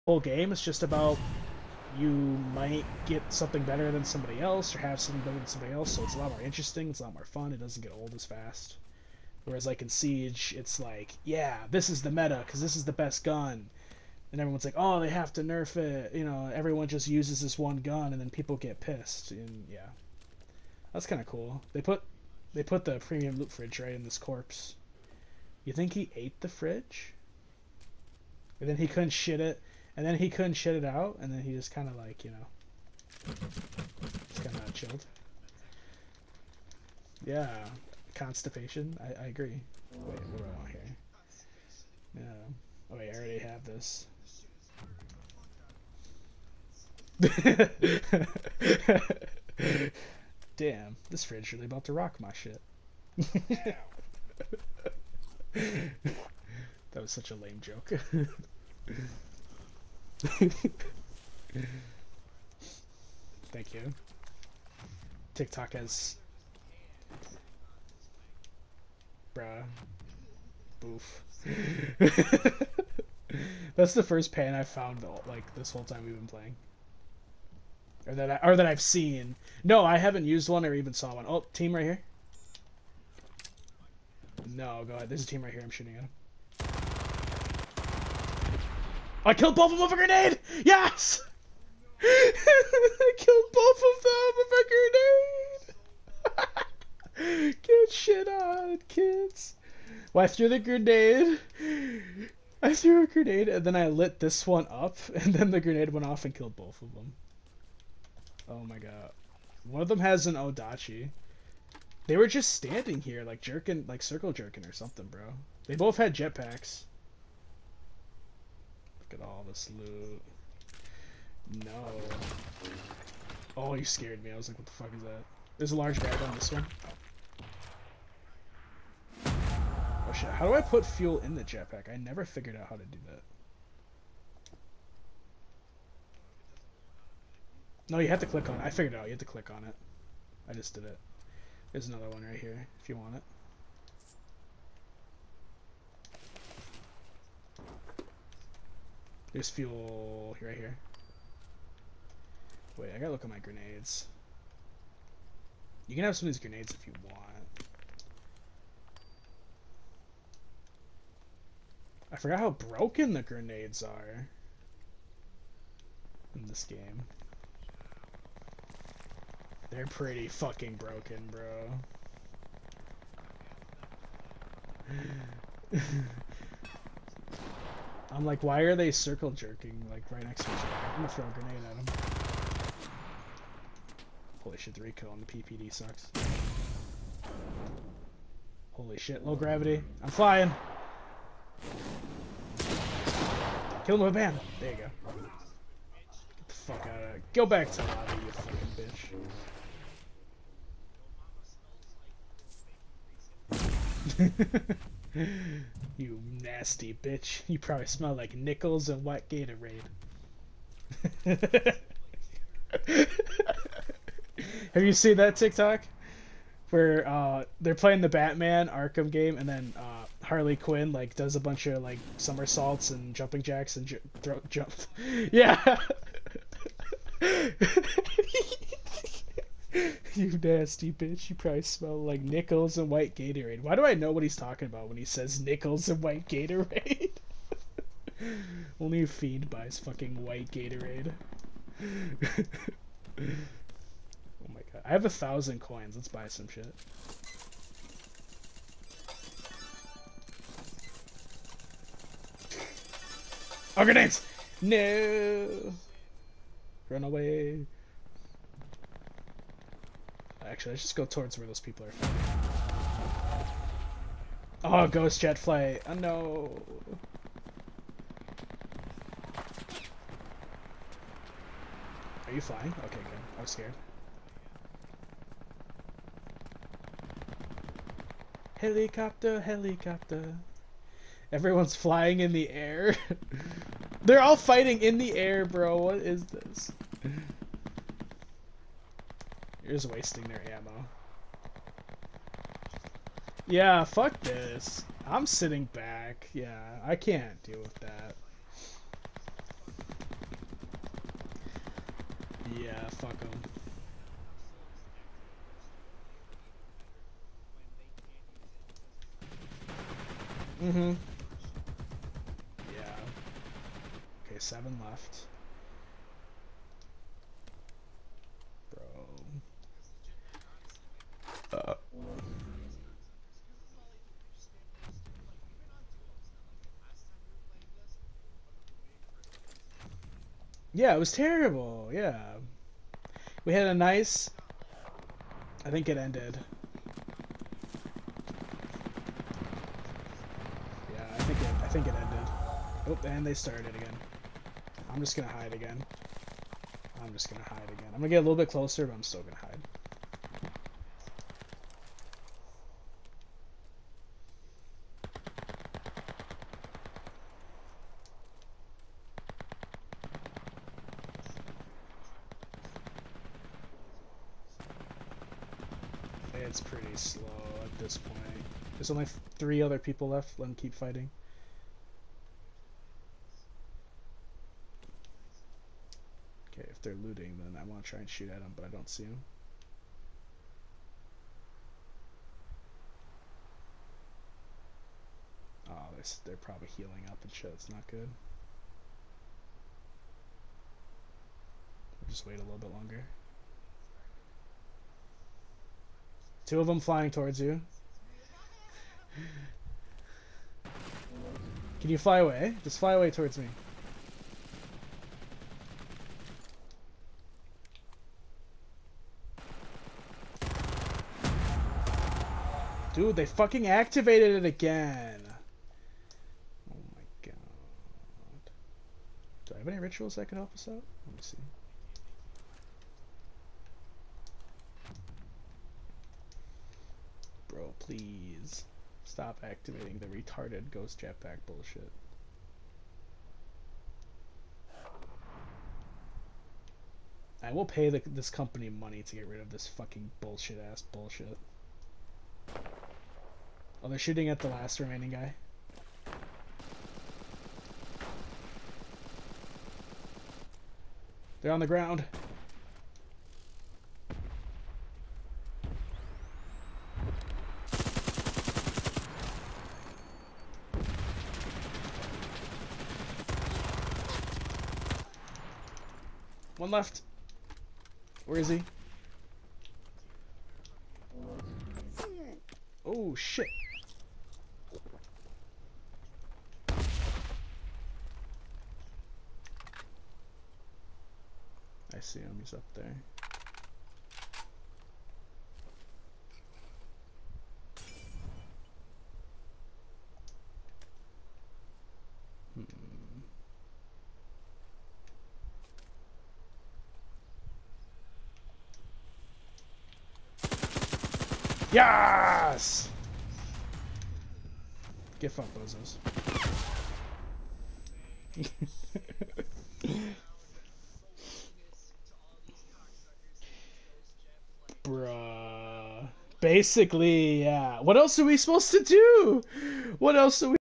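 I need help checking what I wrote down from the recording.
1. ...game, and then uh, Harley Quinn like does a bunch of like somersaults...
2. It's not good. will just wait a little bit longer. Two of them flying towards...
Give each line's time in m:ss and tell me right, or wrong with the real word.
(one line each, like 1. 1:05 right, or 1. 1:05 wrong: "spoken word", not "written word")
1. 3:39 right
2. 6:27 right.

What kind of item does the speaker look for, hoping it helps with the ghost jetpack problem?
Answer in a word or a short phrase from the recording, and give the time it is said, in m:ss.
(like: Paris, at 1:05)
rituals, at 6:59.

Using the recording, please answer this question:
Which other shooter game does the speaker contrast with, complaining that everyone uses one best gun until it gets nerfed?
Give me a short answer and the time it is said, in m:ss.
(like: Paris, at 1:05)
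Siege, at 0:09.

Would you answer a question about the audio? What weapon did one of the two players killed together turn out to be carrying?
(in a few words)
Odachi.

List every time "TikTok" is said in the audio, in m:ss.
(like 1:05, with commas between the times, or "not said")
1:05, 3:35.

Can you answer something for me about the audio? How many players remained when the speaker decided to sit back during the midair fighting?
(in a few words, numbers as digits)
7.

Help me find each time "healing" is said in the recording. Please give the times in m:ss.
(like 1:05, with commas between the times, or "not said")
6:26.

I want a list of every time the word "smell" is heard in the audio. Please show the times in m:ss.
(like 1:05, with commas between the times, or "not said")
3:27, 3:51.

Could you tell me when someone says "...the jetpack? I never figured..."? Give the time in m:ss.
2:11.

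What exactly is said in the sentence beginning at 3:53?
Why do I know what he's talking about when he says nickels and white Gatorade?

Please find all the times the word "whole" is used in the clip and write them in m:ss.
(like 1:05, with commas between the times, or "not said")
0:00, 1:15.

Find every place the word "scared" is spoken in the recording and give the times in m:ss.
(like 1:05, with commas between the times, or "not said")
2:03, 4:33.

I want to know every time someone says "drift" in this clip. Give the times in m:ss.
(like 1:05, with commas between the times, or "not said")
not said.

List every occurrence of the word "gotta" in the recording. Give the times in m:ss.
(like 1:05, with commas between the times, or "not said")
2:32.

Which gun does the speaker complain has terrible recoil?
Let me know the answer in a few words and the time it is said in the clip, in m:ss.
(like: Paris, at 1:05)
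PPD, at 3:05.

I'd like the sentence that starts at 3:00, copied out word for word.
I'm gonna throw a grenade at them.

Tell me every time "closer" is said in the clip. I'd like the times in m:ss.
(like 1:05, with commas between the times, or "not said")
5:48.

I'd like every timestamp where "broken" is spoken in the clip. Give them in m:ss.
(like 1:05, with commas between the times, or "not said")
2:42, 2:50.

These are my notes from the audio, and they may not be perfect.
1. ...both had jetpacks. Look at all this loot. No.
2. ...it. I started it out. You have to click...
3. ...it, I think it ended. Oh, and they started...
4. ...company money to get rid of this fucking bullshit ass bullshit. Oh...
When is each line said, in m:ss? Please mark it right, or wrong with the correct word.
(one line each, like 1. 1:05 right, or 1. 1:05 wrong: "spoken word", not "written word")
1. 1:55 right
2. 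2:18 wrong: "figured", not "started"
3. 5:41 right
4. 7:18 right.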